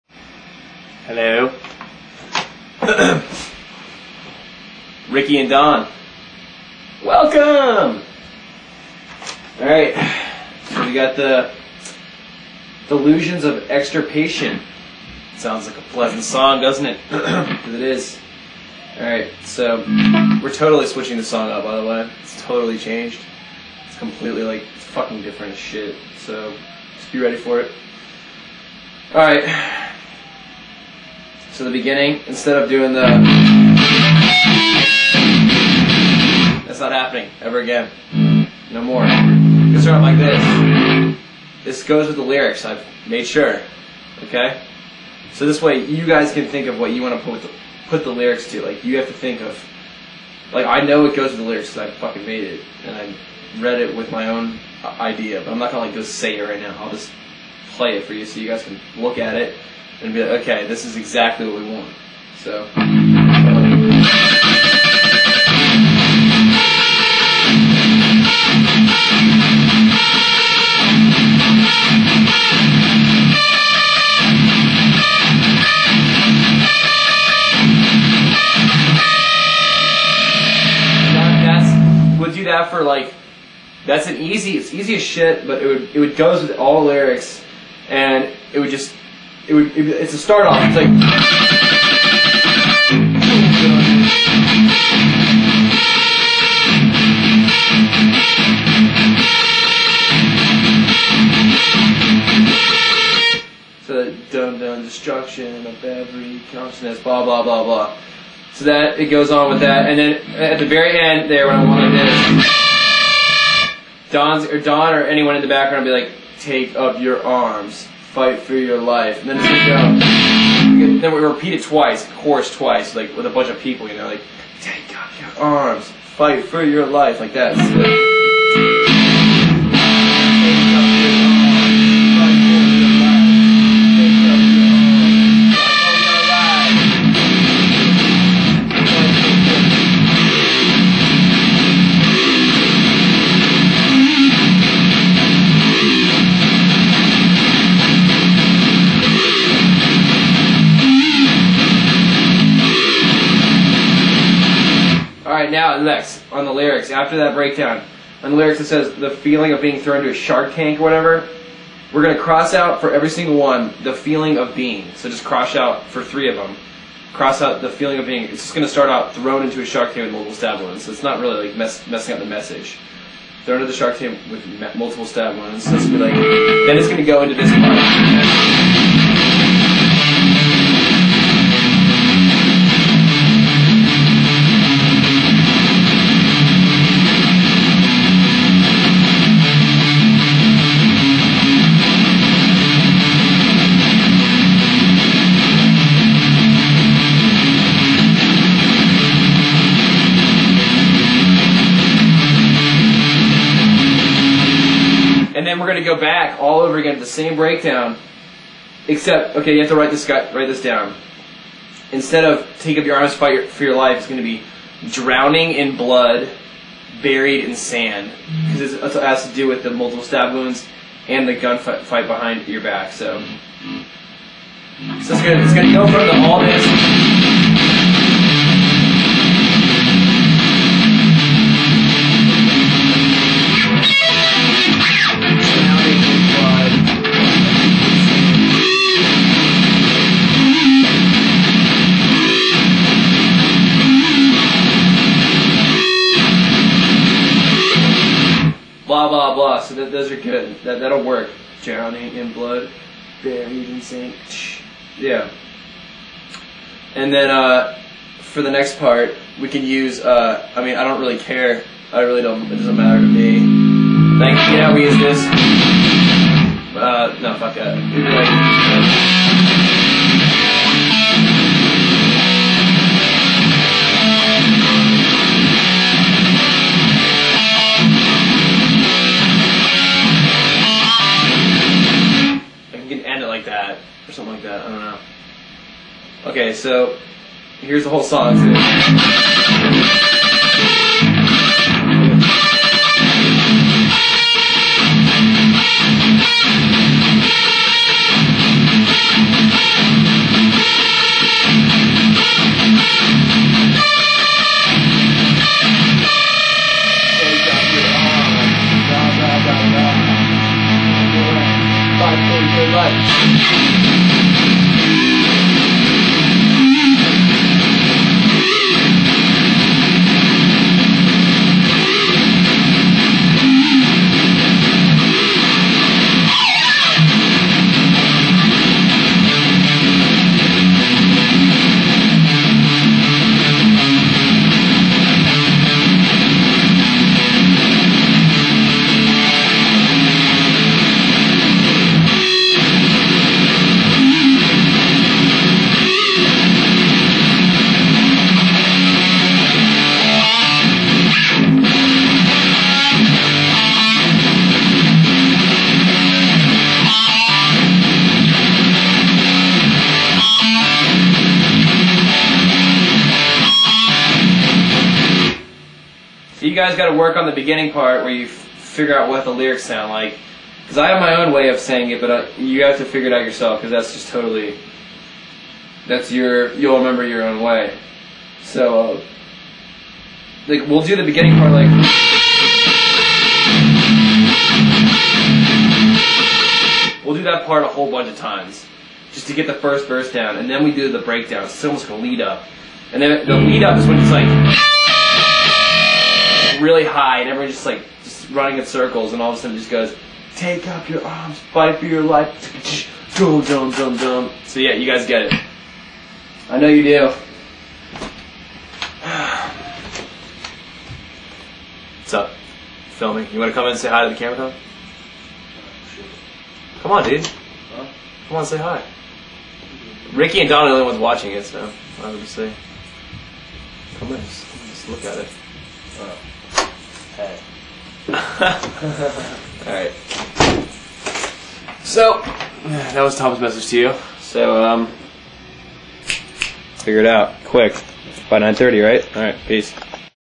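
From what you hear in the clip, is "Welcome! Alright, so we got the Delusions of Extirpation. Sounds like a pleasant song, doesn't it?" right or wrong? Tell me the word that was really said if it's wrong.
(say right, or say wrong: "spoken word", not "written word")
right.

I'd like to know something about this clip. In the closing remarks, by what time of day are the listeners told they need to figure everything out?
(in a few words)
9:30.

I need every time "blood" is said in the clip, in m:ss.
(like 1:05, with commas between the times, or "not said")
3:35, 4:12.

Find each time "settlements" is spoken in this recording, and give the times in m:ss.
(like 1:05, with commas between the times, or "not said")
not said.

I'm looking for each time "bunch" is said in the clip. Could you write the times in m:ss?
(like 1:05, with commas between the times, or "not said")
2:03, 6:27.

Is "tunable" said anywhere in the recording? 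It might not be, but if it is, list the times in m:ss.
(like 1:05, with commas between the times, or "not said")
not said.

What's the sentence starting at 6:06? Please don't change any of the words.
guys got to work on the beginning part where you f- figure out what the lyrics sound like.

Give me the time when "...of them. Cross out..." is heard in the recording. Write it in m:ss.
2:46.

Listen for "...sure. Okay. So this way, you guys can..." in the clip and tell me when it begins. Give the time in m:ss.
0:43.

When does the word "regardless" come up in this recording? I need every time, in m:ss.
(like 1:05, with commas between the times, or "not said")
not said.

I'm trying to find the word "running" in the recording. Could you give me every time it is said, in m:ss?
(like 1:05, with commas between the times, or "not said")
6:38.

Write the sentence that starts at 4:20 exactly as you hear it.
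Uh, I mean, I don't really care.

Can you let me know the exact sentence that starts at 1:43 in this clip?
so, dumb dun destruction of every consciousness, blah blah blah blah.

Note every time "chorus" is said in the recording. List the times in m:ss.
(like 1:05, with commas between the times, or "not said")
2:02.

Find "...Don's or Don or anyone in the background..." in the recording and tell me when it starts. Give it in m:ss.
1:54.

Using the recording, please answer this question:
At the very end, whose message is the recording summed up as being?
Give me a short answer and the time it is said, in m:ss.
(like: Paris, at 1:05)
Tom, at 7:13.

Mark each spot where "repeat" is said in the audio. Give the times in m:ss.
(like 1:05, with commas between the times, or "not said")
2:01.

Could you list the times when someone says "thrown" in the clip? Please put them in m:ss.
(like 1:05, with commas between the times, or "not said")
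2:39, 2:49, 2:53.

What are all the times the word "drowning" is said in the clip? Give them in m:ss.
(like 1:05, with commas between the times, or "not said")
3:34, 4:11.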